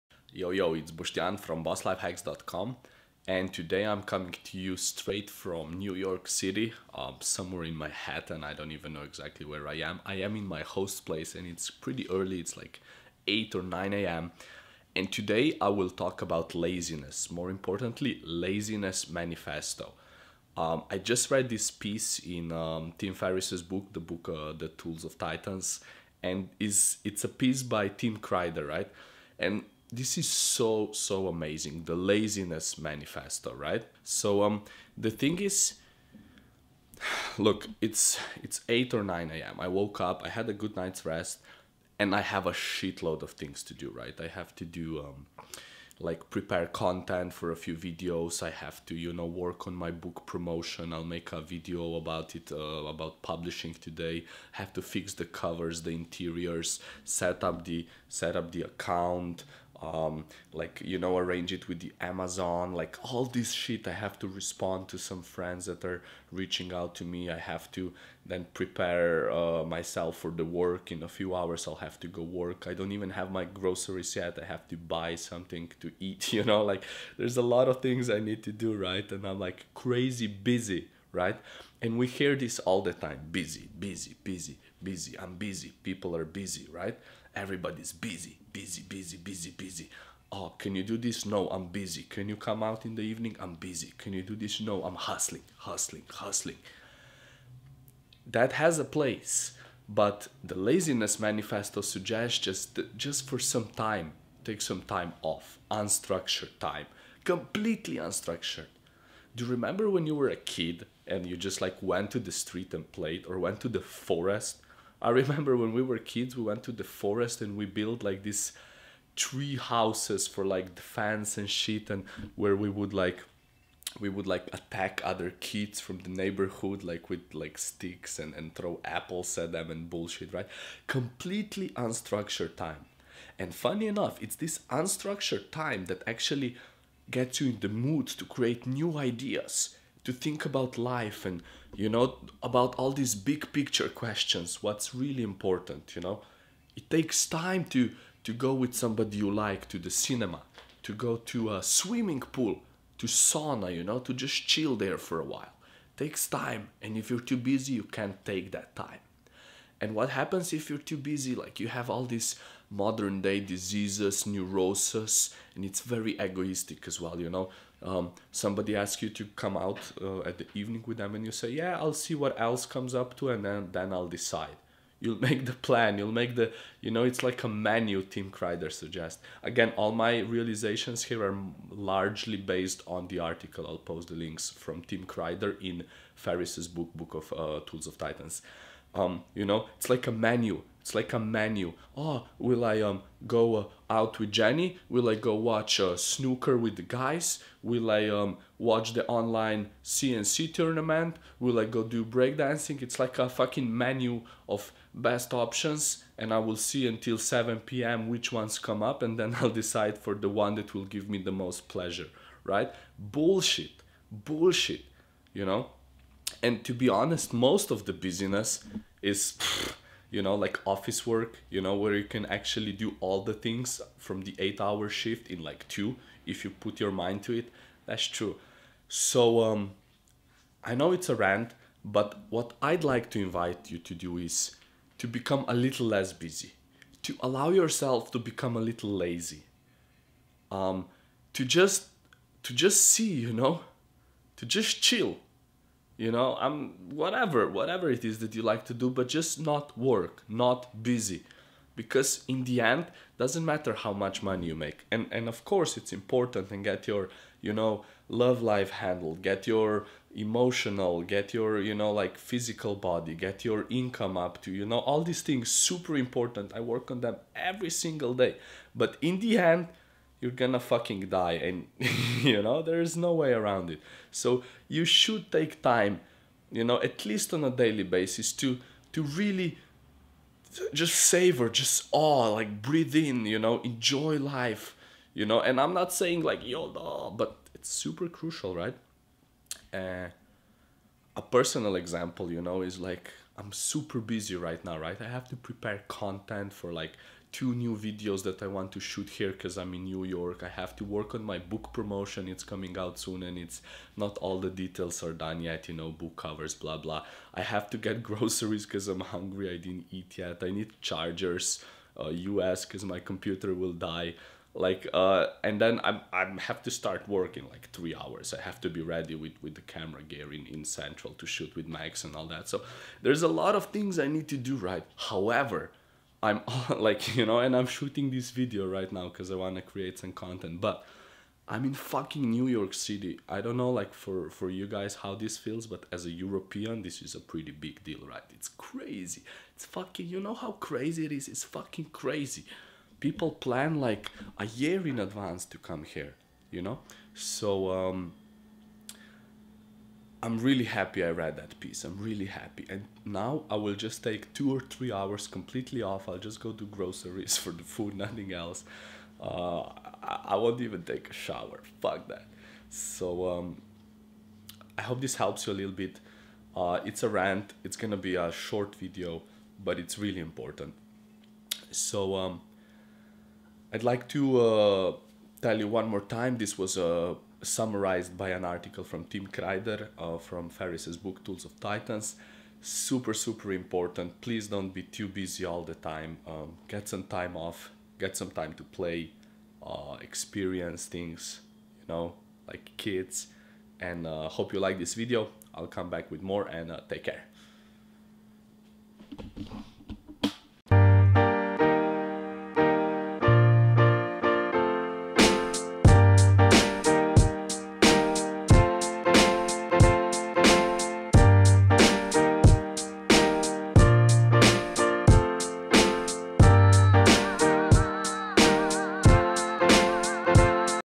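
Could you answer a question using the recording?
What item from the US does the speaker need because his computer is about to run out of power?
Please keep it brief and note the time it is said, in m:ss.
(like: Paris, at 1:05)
Chargers, at 5:10.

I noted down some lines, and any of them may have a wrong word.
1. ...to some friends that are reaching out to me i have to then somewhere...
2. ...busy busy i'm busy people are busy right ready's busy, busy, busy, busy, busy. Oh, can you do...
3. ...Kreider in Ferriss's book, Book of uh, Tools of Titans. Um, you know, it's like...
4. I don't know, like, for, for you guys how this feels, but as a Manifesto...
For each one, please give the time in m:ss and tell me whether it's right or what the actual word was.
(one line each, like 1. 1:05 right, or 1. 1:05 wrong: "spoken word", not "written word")
1. 1:04 wrong: "prepare", not "somewhere"
2. 1:24 wrong: "everybody", not "ready"
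3. 3:05 right
4. 5:33 wrong: "European", not "Manifesto".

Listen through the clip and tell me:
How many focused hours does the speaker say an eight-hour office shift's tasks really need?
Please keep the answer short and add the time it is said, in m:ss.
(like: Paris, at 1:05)
2, at 3:45.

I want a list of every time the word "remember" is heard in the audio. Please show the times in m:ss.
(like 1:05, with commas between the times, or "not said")
1:49, 1:55.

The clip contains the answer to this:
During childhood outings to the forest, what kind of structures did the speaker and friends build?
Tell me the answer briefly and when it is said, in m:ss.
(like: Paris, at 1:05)
Tree houses, at 1:59.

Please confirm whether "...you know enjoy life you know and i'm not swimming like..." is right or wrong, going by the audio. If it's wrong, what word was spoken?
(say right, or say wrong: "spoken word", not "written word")
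wrong: "saying", not "swimming".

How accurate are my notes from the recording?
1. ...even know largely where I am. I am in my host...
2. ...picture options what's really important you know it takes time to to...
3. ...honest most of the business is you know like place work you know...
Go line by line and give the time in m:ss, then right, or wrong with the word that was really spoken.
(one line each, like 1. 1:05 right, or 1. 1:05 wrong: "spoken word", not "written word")
1. 0:08 wrong: "exactly", not "largely"
2. 2:23 wrong: "questions", not "options"
3. 3:36 wrong: "office", not "place".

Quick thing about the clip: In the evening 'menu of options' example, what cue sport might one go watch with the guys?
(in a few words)
Snooker.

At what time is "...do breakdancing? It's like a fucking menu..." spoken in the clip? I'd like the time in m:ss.
3:21.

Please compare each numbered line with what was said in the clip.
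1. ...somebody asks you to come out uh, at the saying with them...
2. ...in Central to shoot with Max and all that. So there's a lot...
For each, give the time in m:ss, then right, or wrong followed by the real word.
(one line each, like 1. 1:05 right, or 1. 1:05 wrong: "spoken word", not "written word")
1. 2:48 wrong: "evening", not "saying"
2. 5:20 right.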